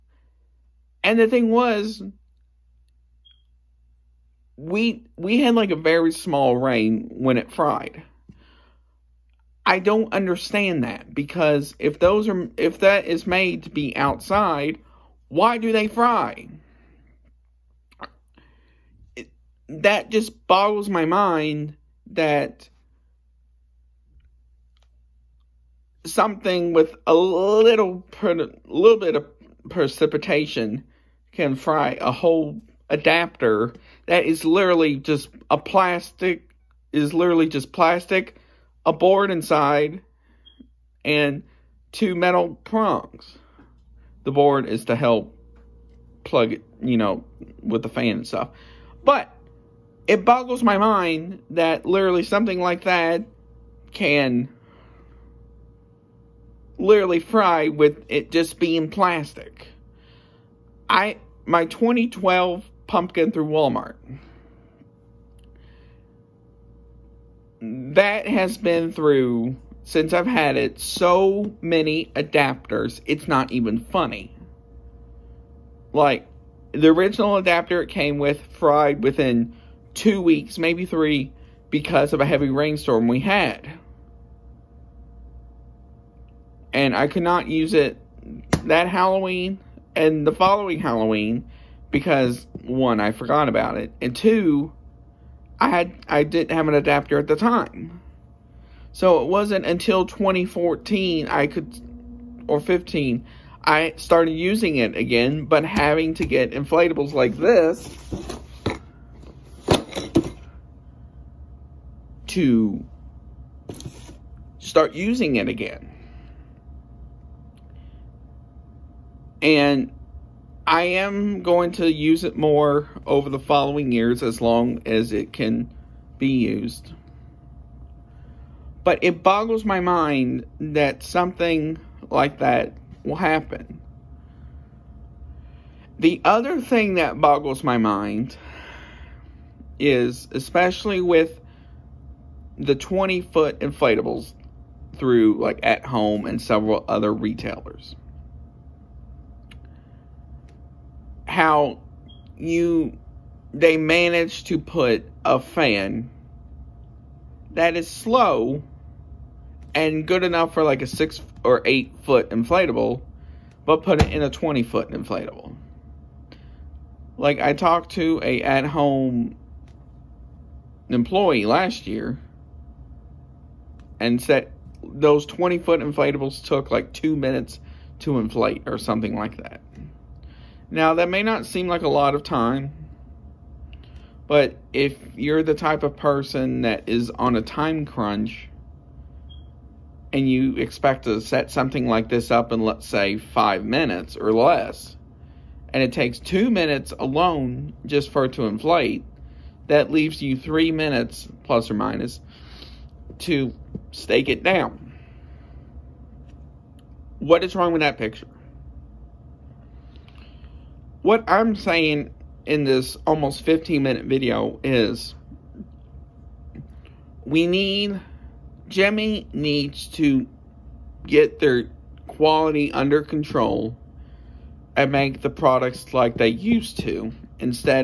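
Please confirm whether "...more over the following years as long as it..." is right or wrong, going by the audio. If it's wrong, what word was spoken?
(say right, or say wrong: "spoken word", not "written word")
right.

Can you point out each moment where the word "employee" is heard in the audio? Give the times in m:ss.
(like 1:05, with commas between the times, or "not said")
2:50.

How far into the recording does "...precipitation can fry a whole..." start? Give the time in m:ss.
0:29.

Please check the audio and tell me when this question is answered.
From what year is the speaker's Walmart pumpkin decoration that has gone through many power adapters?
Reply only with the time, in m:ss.
1:01.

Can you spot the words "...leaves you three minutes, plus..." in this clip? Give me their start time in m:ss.
3:19.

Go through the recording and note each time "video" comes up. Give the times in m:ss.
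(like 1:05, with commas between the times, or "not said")
3:34.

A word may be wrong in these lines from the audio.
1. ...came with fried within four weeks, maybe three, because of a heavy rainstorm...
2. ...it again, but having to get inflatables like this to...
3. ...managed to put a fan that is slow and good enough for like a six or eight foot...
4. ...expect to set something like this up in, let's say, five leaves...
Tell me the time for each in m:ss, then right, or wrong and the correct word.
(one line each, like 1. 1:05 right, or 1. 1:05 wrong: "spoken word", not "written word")
1. 1:17 wrong: "two", not "four"
2. 1:44 right
3. 2:33 right
4. 3:10 wrong: "minutes", not "leaves".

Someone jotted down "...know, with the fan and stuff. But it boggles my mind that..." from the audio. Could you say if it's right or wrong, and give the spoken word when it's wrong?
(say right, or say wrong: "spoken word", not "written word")
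right.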